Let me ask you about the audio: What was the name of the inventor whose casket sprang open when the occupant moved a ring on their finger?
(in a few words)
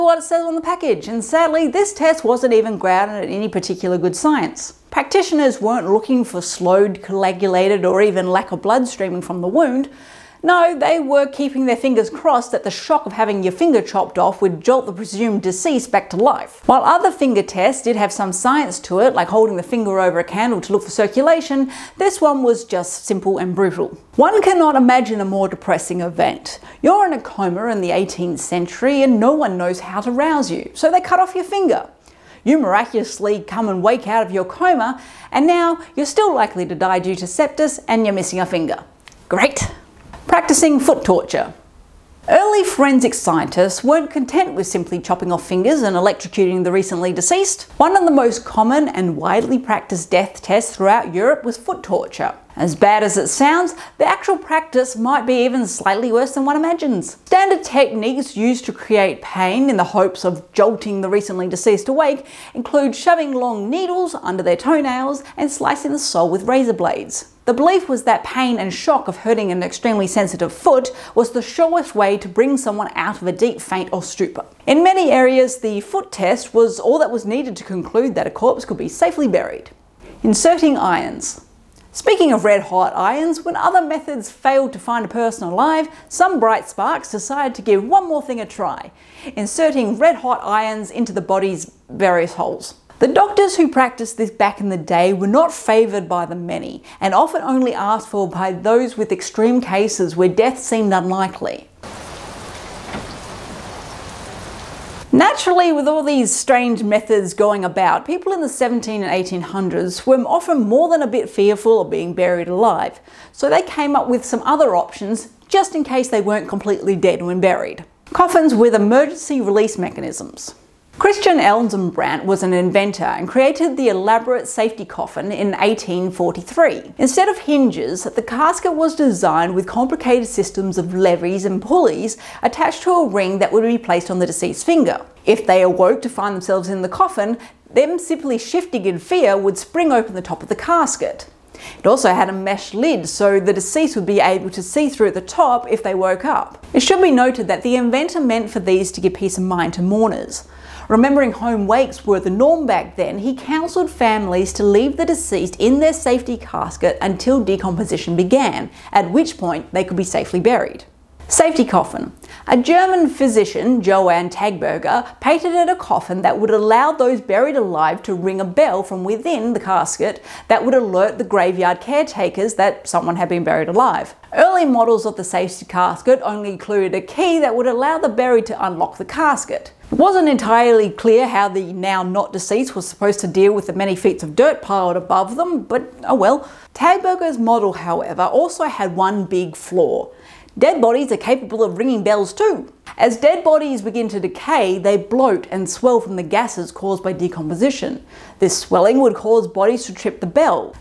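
Christian Eisenbrandt.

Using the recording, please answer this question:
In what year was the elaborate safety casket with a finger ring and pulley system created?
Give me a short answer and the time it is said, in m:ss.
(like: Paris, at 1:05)
1843, at 2:05.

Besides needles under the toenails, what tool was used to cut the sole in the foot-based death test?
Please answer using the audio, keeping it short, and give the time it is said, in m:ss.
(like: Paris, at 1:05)
razor blades, at 1:06.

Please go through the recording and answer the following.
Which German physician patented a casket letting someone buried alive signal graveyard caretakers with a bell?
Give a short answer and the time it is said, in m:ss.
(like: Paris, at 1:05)
Johann Taberger, at 2:43.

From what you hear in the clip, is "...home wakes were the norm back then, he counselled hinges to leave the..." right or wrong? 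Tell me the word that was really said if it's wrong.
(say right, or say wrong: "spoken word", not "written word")
wrong: "families", not "hinges".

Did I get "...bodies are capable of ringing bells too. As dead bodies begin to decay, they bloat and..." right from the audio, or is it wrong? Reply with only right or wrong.
right.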